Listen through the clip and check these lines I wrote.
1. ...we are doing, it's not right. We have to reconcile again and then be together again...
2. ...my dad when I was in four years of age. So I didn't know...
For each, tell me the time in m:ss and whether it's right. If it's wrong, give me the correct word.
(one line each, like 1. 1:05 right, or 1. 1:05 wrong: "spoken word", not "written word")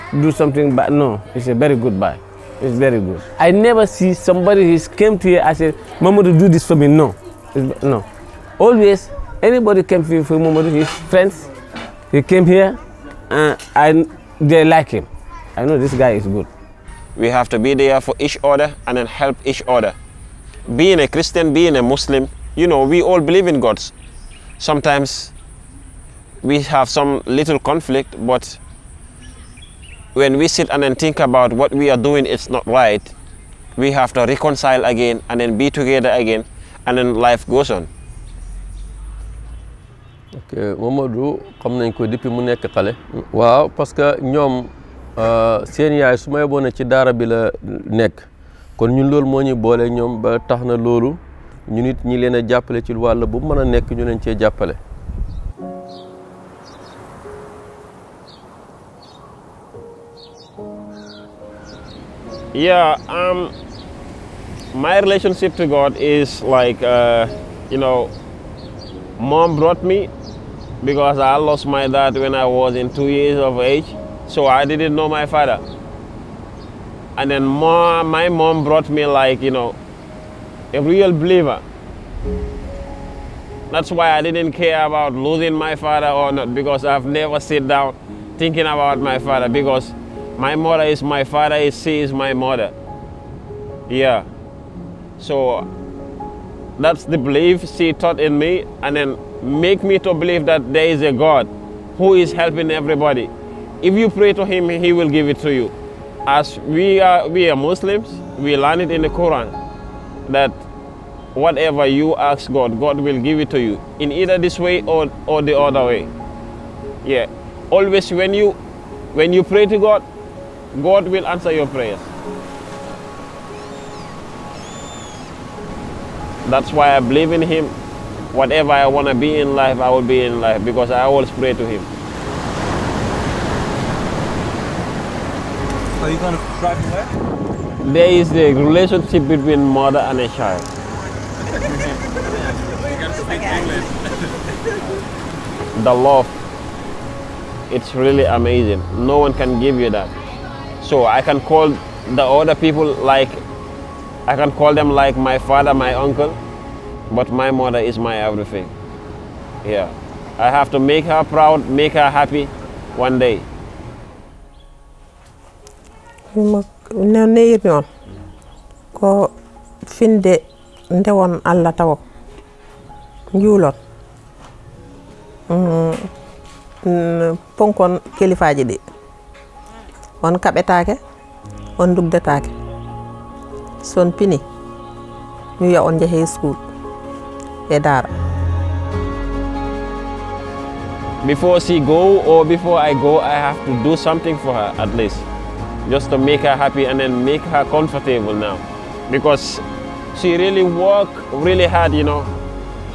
1. 0:31 right
2. 1:11 wrong: "two", not "four".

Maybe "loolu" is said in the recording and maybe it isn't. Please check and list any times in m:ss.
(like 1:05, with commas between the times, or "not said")
0:50.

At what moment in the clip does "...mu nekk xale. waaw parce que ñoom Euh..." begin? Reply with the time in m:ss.
0:42.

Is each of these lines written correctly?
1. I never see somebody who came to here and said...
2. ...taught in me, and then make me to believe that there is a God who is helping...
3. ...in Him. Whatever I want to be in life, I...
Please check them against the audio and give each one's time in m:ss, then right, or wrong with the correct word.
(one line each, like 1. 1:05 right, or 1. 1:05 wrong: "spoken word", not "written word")
1. 0:03 right
2. 1:37 right
3. 2:07 right.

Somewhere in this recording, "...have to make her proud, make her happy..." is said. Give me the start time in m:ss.
2:40.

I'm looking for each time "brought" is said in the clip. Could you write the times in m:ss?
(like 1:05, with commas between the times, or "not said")
1:09, 1:18.